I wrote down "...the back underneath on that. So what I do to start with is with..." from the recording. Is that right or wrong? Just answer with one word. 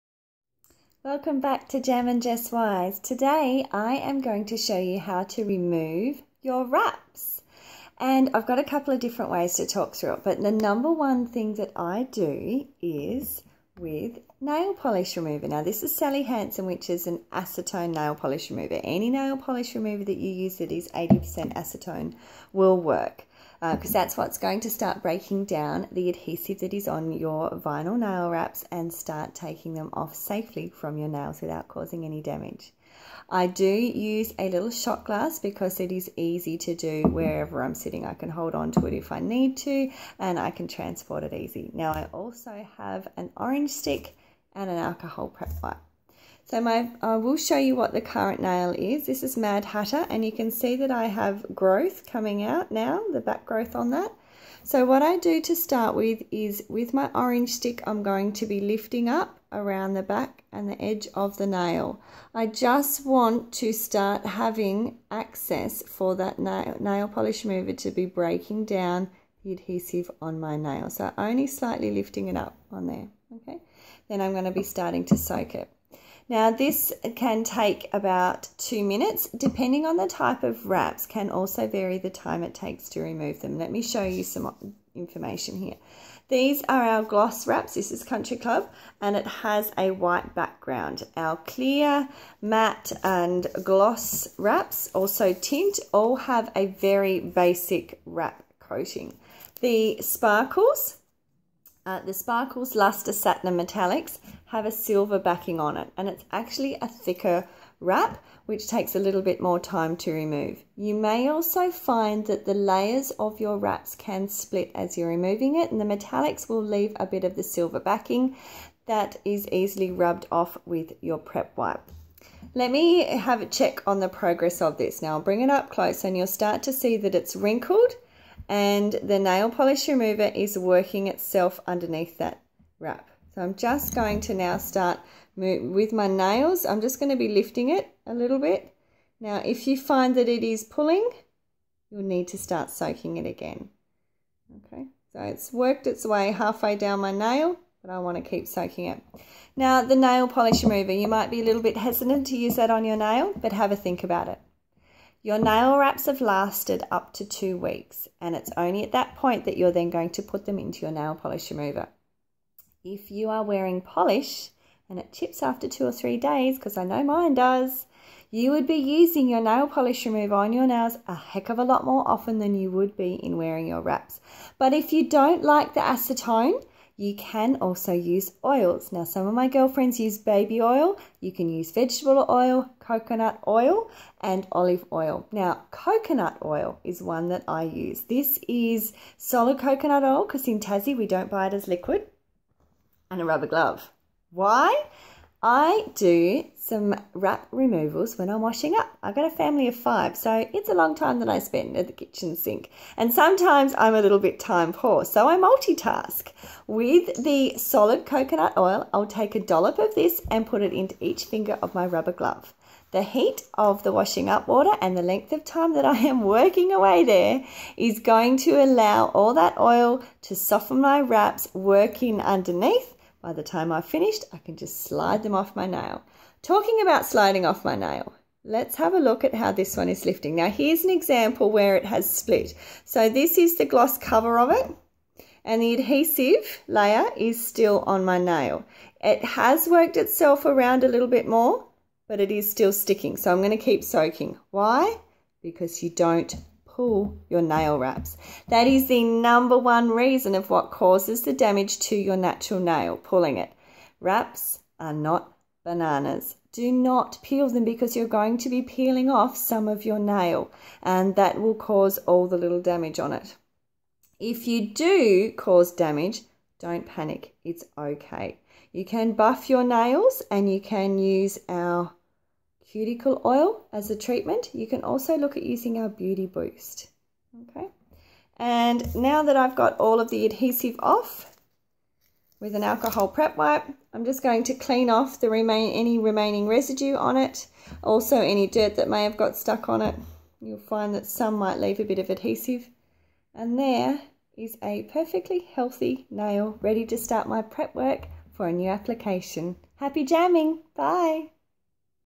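wrong.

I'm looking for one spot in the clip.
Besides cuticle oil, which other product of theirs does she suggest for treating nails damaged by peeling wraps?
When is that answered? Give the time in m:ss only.
4:35.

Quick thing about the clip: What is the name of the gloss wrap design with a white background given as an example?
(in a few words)
Country Club.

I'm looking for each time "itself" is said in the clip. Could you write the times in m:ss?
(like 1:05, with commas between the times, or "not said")
2:11, 3:59.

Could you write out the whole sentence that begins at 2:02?
Let me have a check on the progress of this.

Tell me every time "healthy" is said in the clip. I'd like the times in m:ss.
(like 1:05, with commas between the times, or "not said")
4:55.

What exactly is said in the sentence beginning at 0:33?
I do use a little shot glass because it is easy to do wherever I'm sitting.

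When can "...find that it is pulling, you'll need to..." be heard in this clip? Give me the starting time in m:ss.
2:19.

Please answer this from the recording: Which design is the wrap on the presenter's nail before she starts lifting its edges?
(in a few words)
Mad Hatter.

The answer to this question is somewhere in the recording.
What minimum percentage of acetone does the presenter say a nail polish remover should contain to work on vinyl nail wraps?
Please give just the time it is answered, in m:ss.
0:20.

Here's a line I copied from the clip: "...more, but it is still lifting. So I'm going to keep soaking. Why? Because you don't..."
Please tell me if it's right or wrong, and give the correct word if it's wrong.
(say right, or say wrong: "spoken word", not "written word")
wrong: "sticking", not "lifting".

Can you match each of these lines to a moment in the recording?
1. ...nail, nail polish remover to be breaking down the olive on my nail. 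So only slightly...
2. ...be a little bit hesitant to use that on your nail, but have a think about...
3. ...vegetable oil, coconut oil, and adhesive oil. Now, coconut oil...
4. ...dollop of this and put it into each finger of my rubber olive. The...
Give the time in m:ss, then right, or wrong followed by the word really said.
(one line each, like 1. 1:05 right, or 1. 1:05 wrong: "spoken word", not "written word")
1. 1:06 wrong: "adhesive", not "olive"
2. 2:31 right
3. 3:01 wrong: "olive", not "adhesive"
4. 3:29 wrong: "glove", not "olive".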